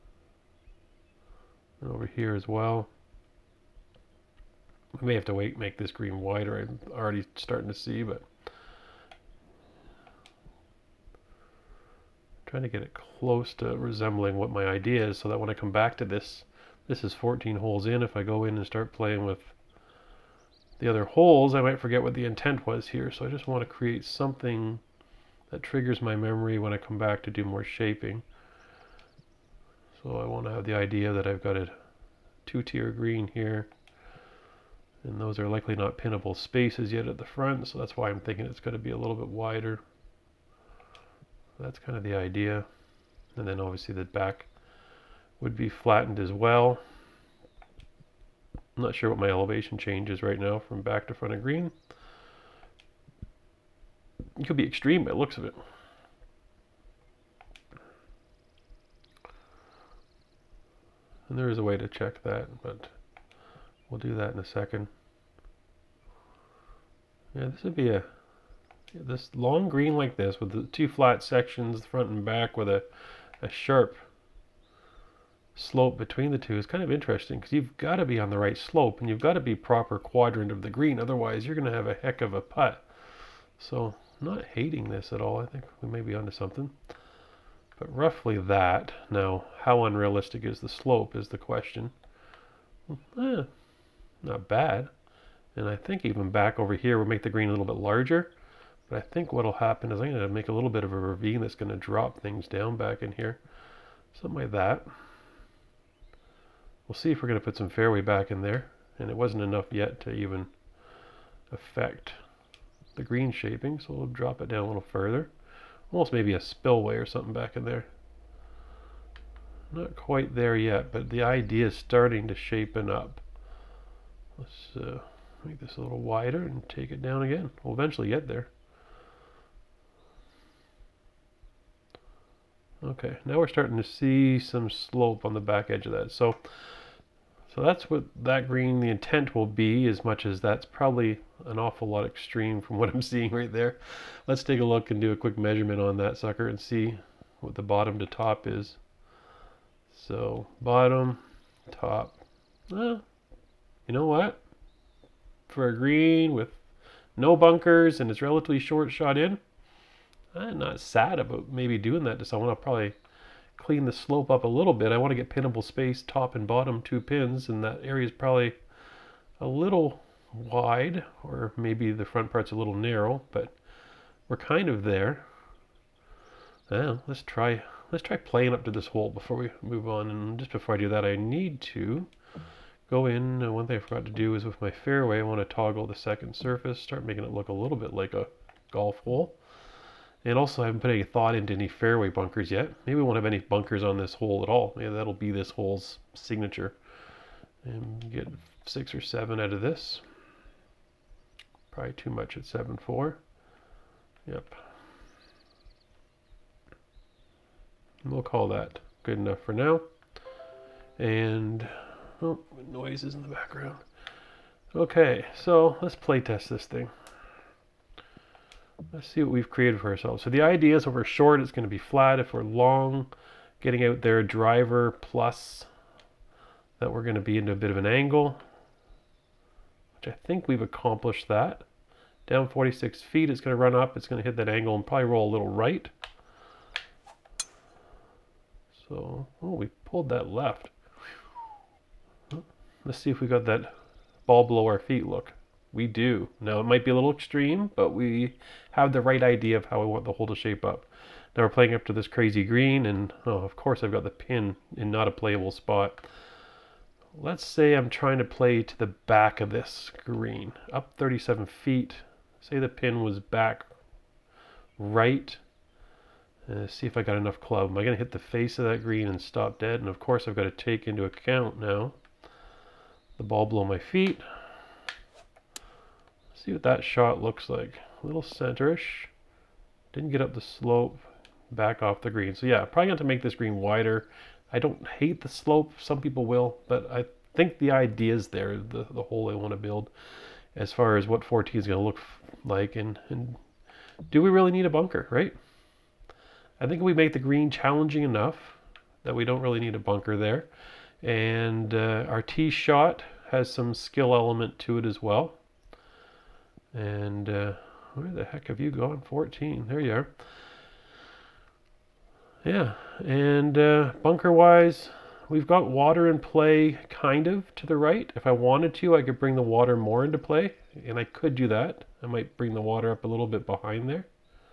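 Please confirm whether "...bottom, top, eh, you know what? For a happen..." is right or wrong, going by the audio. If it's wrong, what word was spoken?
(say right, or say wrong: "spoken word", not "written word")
wrong: "green", not "happen".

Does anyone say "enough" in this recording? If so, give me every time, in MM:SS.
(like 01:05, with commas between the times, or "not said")
01:49, 03:29, 04:27, 04:58.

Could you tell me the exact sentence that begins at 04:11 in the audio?
Now we're playing up to this crazy green, and oh, of course I've got the pin in not a playable spot.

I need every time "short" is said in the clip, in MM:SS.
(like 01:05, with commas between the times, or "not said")
02:38, 03:41.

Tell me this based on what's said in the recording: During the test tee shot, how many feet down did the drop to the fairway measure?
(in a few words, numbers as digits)
46.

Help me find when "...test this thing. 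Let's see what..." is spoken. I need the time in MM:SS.
03:36.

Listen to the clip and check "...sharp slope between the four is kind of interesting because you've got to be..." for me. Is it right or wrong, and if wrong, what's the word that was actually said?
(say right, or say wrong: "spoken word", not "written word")
wrong: "two", not "four".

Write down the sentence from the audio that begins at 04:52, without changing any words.
And, and do we really need a bunker, right?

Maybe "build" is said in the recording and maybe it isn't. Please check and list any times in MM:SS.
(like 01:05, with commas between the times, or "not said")
04:49.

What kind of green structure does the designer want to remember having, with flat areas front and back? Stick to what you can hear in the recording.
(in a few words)
two-tier green.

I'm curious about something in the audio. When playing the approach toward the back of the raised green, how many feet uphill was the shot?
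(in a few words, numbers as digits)
37.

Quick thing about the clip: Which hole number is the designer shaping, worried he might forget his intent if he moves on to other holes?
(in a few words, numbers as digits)
14.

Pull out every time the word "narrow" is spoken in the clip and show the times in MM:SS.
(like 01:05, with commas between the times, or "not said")
02:52.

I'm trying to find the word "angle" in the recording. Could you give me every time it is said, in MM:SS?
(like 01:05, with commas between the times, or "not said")
03:47, 03:54.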